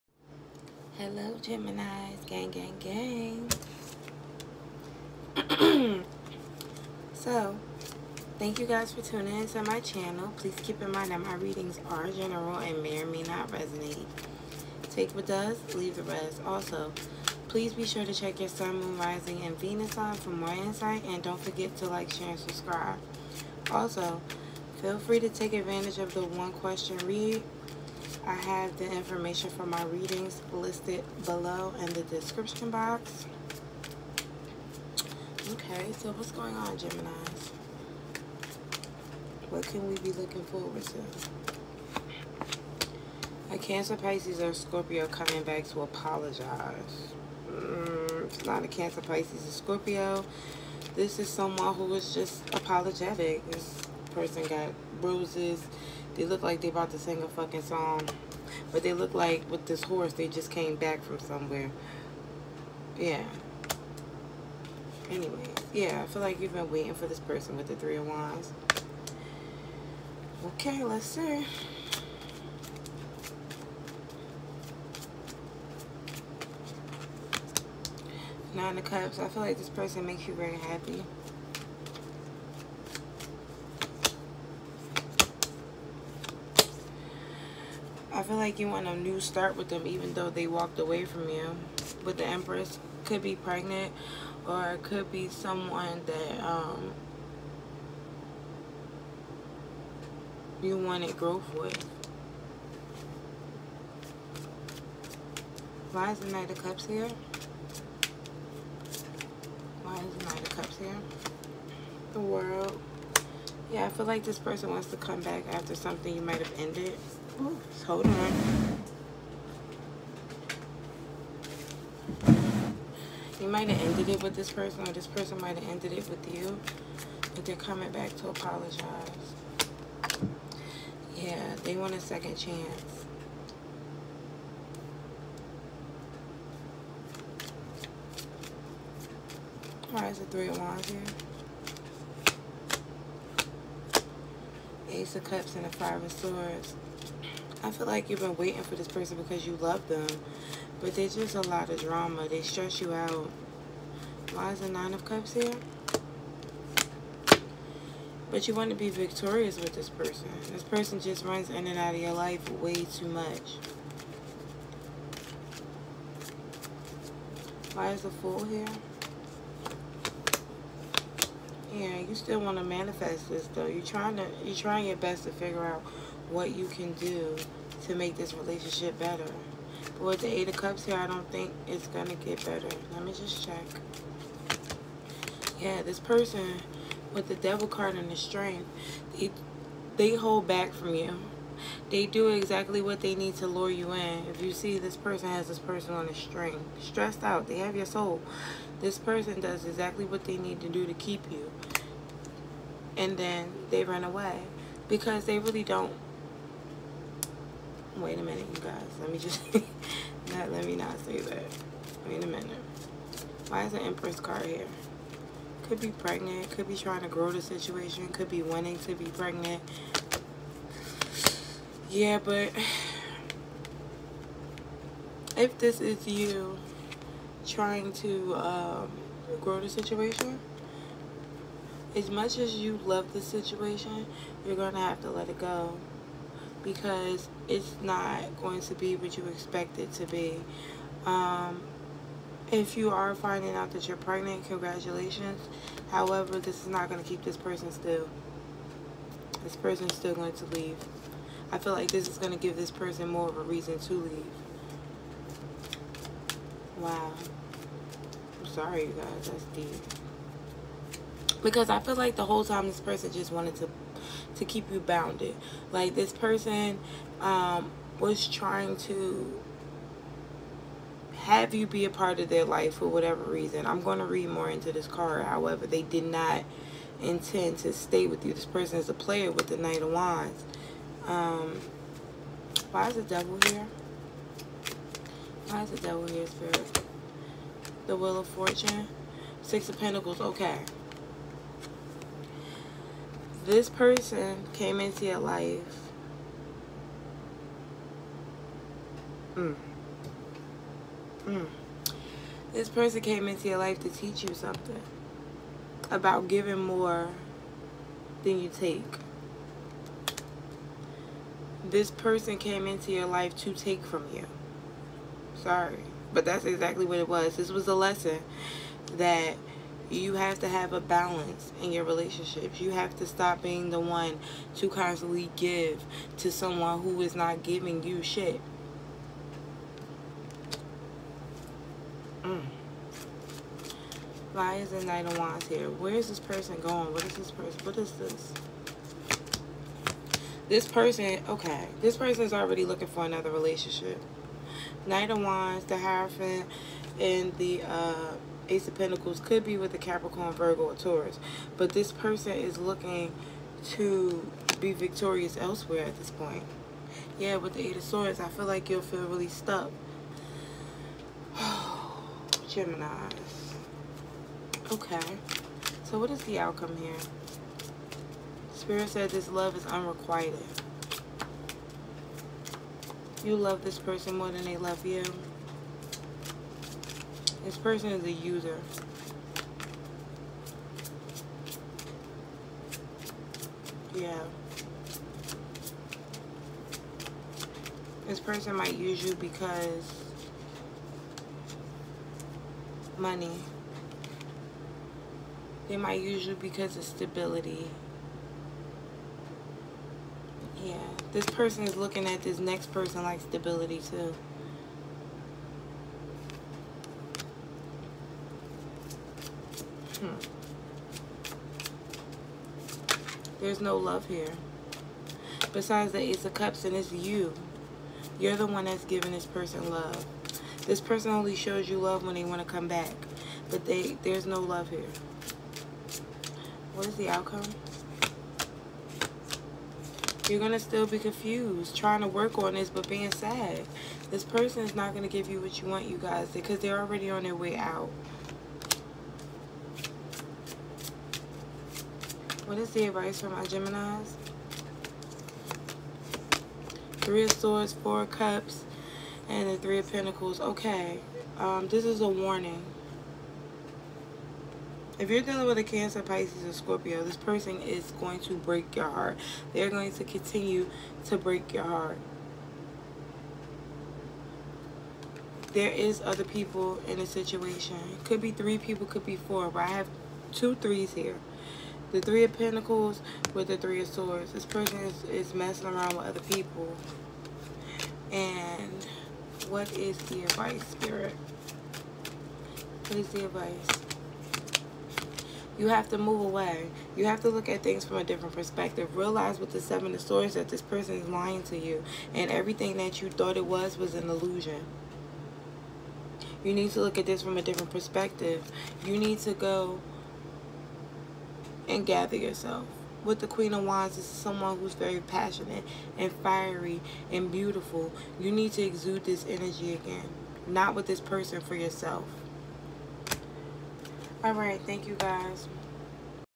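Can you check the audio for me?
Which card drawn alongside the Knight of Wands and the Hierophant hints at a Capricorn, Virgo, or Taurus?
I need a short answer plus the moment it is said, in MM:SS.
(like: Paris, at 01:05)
Ace of Pentacles, at 05:48.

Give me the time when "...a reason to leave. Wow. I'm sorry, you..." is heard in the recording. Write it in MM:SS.
04:13.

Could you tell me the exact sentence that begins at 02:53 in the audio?
You're trying to, you're trying your best to figure out what you can do to make this relationship better.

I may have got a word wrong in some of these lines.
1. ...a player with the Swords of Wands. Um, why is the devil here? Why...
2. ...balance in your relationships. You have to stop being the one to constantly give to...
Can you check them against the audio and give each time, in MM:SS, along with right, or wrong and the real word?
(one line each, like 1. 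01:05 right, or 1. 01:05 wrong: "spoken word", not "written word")
1. 04:38 wrong: "Knight", not "Swords"
2. 05:20 right.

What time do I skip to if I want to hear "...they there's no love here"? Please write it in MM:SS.
07:03.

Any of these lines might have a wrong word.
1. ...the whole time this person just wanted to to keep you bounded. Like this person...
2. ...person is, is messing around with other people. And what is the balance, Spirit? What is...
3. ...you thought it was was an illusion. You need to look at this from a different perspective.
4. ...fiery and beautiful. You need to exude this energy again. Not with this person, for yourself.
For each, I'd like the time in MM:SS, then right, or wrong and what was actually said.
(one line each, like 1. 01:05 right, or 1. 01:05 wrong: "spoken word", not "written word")
1. 04:22 right
2. 07:54 wrong: "advice", not "balance"
3. 08:12 right
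4. 08:26 right.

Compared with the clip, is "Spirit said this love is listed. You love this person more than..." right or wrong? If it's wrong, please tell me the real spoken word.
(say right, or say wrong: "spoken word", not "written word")
wrong: "unrequited", not "listed".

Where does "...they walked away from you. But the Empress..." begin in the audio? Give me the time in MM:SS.
01:30.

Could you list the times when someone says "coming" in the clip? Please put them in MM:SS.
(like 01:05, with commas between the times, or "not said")
00:45, 02:07.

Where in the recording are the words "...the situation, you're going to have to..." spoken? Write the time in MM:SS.
03:53.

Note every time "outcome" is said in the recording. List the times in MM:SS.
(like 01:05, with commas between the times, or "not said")
06:06, 07:07.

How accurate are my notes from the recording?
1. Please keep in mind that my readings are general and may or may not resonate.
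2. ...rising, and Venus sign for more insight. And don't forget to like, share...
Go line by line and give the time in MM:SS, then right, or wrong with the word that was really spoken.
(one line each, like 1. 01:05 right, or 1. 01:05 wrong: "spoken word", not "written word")
1. 00:10 right
2. 00:18 right.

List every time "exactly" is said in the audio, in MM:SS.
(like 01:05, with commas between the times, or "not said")
03:12, 03:19, 05:16.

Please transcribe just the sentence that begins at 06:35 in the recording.
They might use you because of stability.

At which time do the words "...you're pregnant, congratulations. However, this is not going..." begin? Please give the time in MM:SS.
04:03.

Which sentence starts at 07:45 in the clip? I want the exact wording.
There is other people in the situation.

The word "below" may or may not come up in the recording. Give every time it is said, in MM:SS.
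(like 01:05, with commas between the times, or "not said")
00:31.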